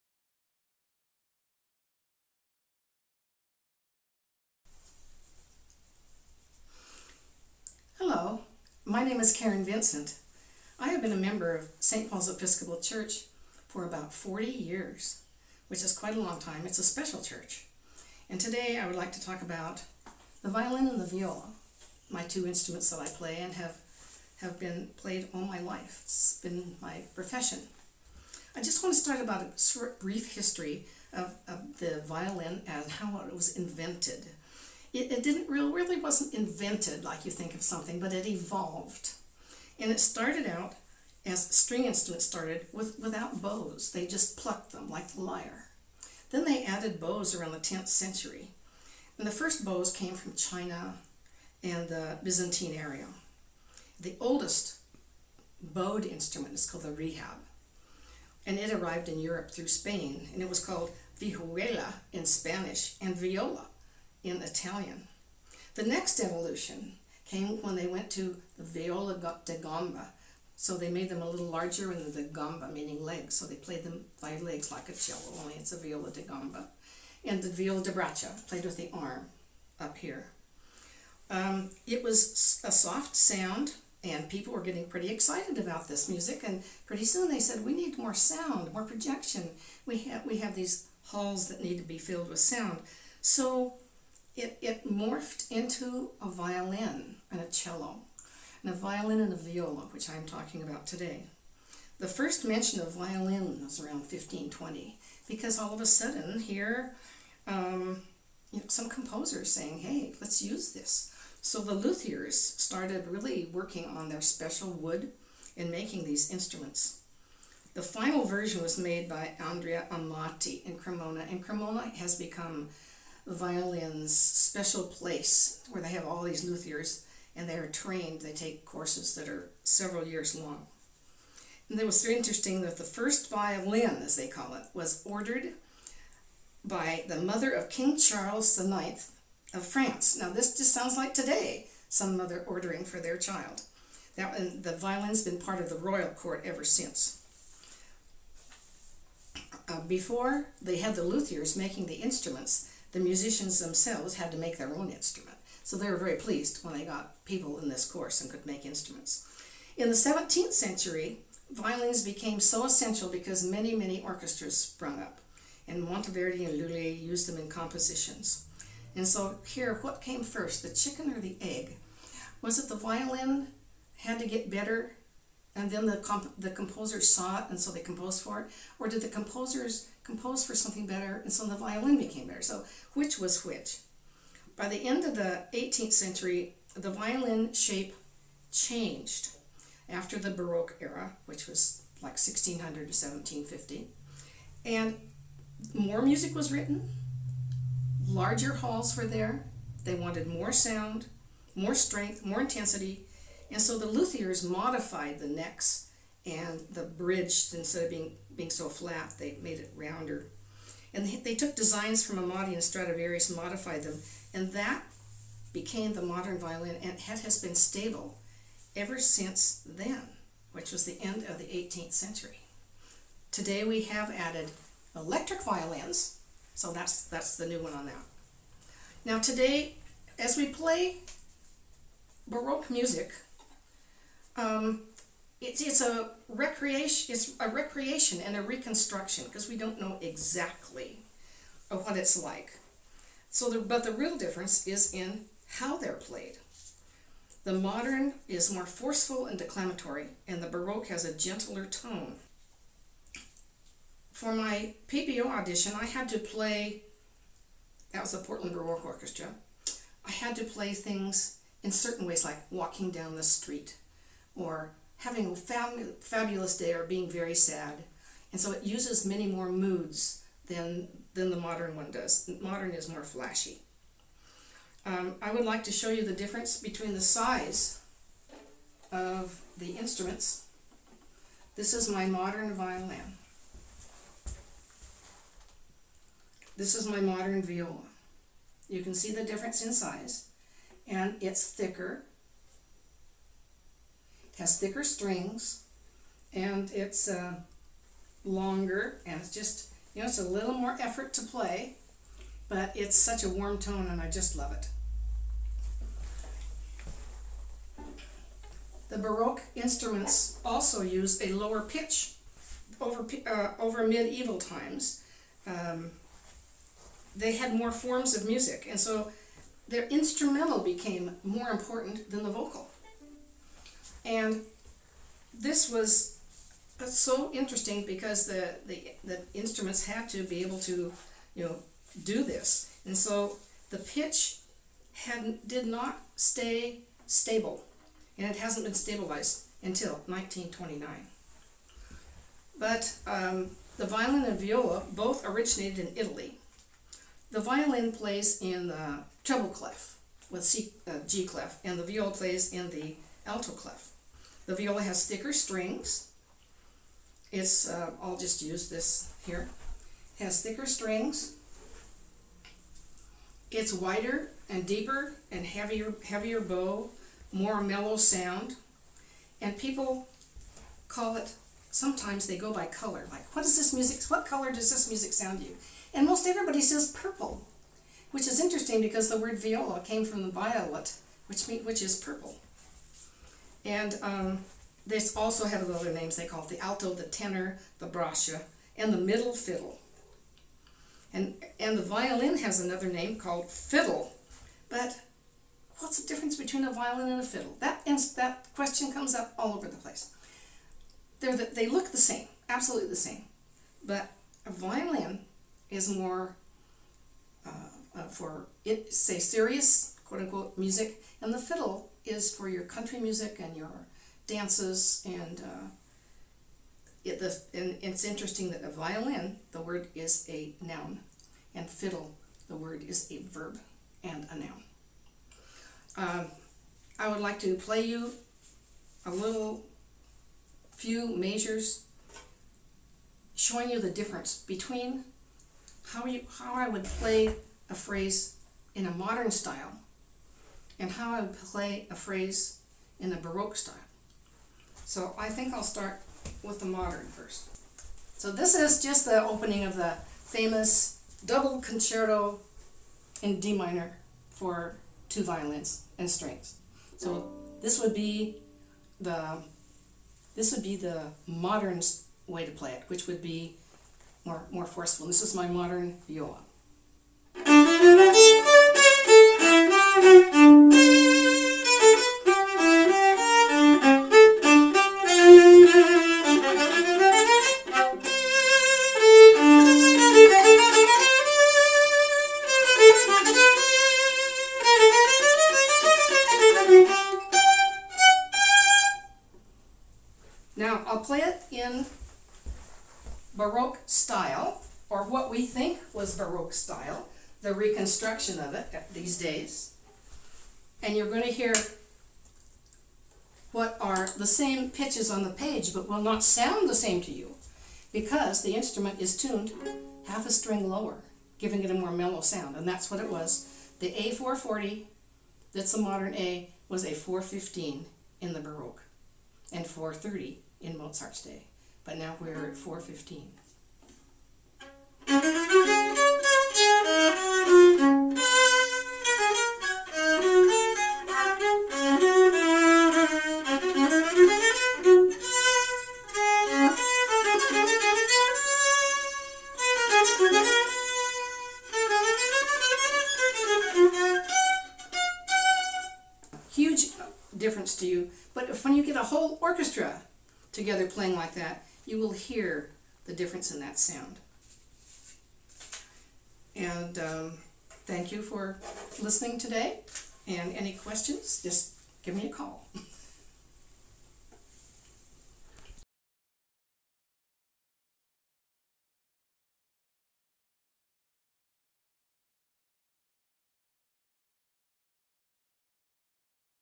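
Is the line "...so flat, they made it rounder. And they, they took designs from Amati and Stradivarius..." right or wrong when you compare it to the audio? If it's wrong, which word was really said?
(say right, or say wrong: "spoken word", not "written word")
right.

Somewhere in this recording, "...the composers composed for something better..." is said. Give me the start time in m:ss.
2:59.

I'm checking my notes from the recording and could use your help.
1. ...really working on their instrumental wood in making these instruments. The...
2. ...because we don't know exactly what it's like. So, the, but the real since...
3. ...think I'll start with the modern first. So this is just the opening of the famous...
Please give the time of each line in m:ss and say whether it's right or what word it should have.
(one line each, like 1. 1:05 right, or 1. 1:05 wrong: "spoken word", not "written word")
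1. 1:53 wrong: "special", not "instrumental"
2. 3:59 wrong: "difference", not "since"
3. 7:25 right.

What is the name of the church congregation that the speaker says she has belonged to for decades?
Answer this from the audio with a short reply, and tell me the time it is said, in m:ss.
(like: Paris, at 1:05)
St. Paul's Episcopal Church, at 0:11.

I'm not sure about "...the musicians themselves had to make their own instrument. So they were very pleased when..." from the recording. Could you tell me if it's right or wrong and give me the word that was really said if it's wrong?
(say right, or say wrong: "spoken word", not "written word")
right.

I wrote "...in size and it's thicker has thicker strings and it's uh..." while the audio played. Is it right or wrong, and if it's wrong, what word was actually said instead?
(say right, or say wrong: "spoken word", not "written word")
right.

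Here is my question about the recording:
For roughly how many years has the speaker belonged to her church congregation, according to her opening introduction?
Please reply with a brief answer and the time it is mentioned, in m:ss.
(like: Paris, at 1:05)
40 years, at 0:13.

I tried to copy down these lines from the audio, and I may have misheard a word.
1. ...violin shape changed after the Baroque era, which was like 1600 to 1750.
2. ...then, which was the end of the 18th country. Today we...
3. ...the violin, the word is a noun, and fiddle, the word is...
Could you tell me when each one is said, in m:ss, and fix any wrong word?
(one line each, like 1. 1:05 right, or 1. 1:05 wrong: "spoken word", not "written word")
1. 3:06 right
2. 3:39 wrong: "century", not "country"
3. 6:58 right.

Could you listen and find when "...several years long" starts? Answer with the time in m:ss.
2:09.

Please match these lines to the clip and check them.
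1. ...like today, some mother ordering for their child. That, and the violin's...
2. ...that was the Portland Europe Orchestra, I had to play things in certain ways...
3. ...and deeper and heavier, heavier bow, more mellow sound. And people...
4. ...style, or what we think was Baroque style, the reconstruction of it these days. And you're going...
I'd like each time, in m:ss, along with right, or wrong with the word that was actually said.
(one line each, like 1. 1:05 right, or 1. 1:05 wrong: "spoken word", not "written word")
1. 2:20 right
2. 4:17 wrong: "Baroque", not "Europe"
3. 6:04 right
4. 8:13 right.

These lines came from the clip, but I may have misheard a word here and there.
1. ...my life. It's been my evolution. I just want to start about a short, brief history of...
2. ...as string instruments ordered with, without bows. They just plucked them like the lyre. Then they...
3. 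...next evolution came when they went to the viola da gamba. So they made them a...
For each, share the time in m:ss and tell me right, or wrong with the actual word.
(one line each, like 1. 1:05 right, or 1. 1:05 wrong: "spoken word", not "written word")
1. 0:25 wrong: "profession", not "evolution"
2. 0:41 wrong: "started", not "ordered"
3. 1:05 right.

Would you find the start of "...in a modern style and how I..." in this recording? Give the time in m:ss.
7:18.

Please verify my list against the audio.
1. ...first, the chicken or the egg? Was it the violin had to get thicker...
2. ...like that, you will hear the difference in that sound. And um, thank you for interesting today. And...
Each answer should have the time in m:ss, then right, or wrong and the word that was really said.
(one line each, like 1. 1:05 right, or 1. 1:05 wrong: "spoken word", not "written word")
1. 2:50 wrong: "better", not "thicker"
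2. 9:11 wrong: "listening", not "interesting".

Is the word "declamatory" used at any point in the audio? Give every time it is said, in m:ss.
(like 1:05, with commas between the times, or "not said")
4:09.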